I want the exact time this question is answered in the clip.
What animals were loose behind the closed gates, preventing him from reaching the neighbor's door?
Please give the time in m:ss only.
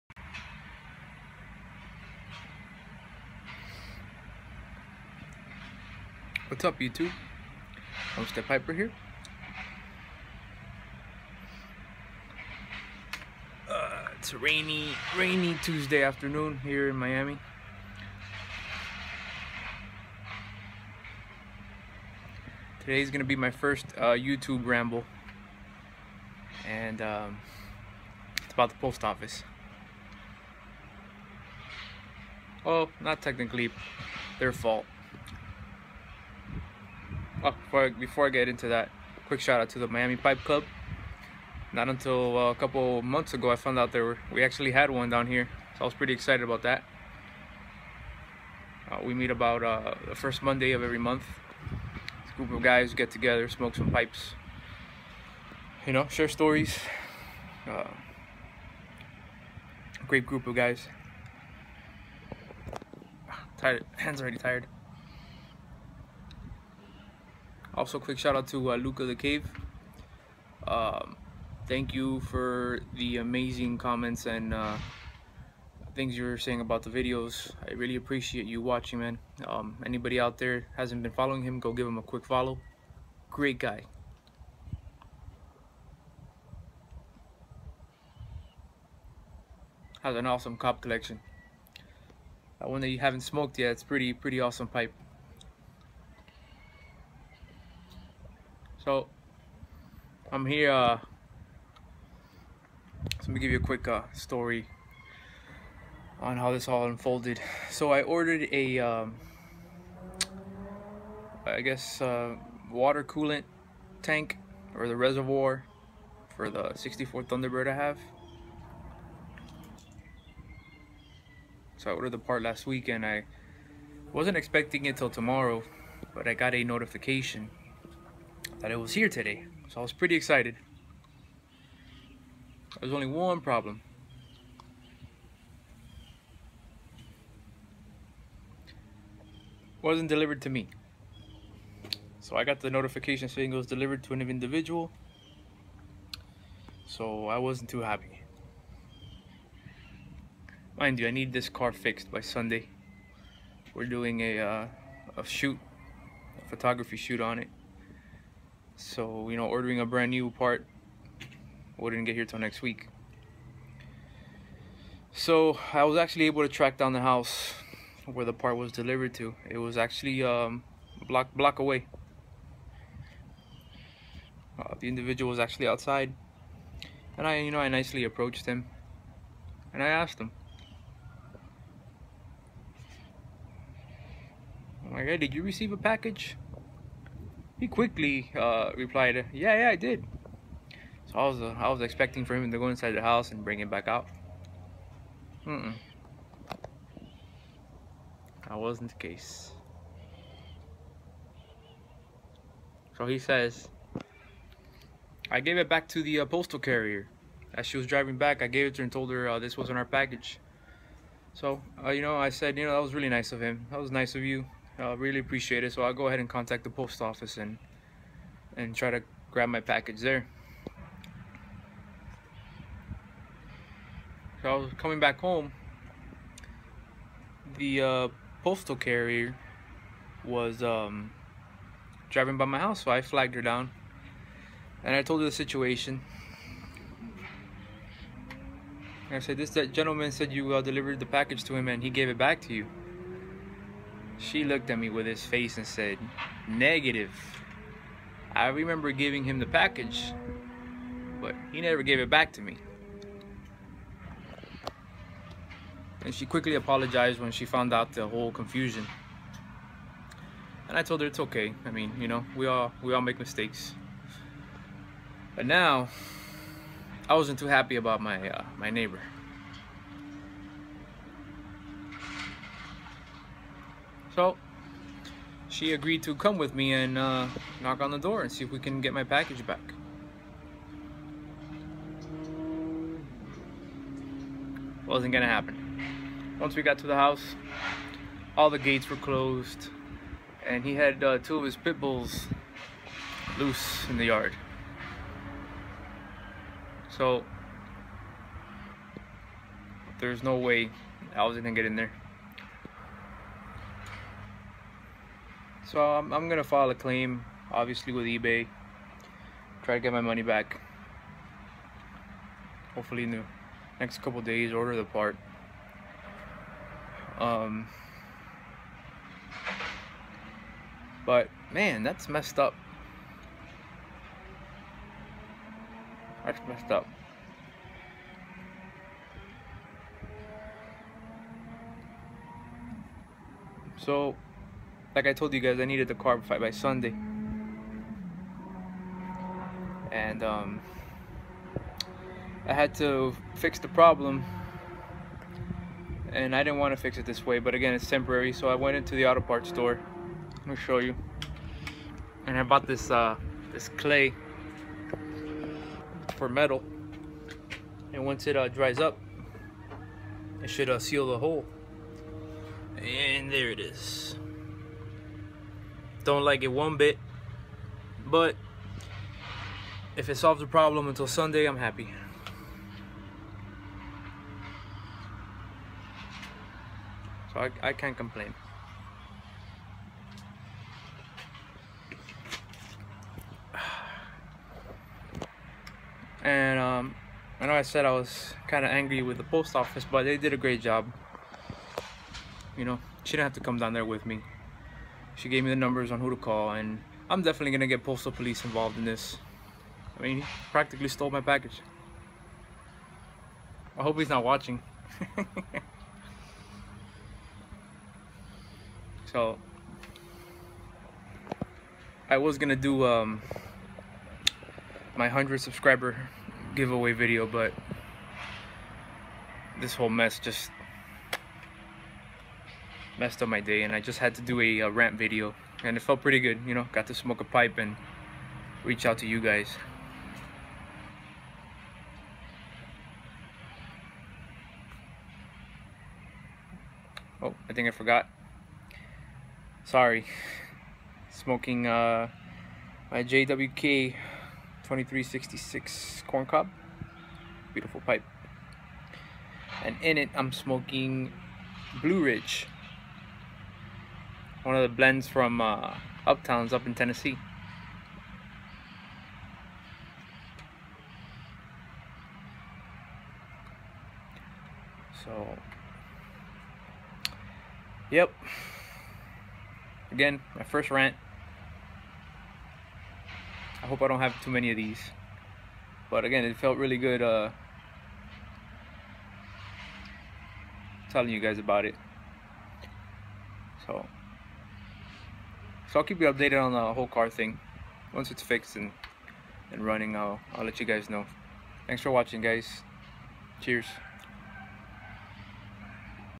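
4:51.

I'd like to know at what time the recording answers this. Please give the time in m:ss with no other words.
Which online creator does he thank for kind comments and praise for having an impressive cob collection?
1:08.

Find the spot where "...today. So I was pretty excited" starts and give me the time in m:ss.
2:09.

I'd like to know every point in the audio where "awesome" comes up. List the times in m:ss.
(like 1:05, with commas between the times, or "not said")
1:30, 1:34.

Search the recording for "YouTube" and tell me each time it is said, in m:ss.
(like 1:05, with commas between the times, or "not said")
0:06, 0:24.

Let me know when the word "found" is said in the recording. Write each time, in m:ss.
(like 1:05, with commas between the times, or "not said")
0:43, 4:17.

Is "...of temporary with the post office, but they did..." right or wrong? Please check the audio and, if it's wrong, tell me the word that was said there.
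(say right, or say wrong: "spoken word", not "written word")
wrong: "angry", not "temporary".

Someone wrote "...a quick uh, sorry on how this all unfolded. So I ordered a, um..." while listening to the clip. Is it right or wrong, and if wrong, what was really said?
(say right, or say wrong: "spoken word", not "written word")
wrong: "story", not "sorry".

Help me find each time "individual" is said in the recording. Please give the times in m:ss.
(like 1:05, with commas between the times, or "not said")
2:24, 2:54.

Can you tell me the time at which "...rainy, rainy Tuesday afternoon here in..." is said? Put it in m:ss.
0:14.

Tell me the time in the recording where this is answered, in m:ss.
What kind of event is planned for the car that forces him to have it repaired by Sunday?
2:36.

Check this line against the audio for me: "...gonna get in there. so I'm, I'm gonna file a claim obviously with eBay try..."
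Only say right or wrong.
right.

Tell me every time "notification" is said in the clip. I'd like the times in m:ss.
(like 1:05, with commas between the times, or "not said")
2:06, 2:22.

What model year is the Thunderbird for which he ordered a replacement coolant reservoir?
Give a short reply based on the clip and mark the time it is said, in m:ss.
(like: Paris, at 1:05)
1964, at 1:56.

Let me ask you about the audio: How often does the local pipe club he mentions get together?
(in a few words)
First Monday of every month.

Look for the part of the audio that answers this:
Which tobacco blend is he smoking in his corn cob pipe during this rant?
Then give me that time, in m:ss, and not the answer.
7:31.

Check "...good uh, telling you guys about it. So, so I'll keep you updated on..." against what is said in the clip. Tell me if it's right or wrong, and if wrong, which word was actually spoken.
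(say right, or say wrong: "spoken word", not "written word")
right.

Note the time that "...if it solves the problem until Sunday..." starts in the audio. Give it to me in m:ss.
6:09.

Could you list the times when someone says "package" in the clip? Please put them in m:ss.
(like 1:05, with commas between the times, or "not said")
3:05, 3:29, 3:39, 4:01, 4:09, 4:39, 6:41.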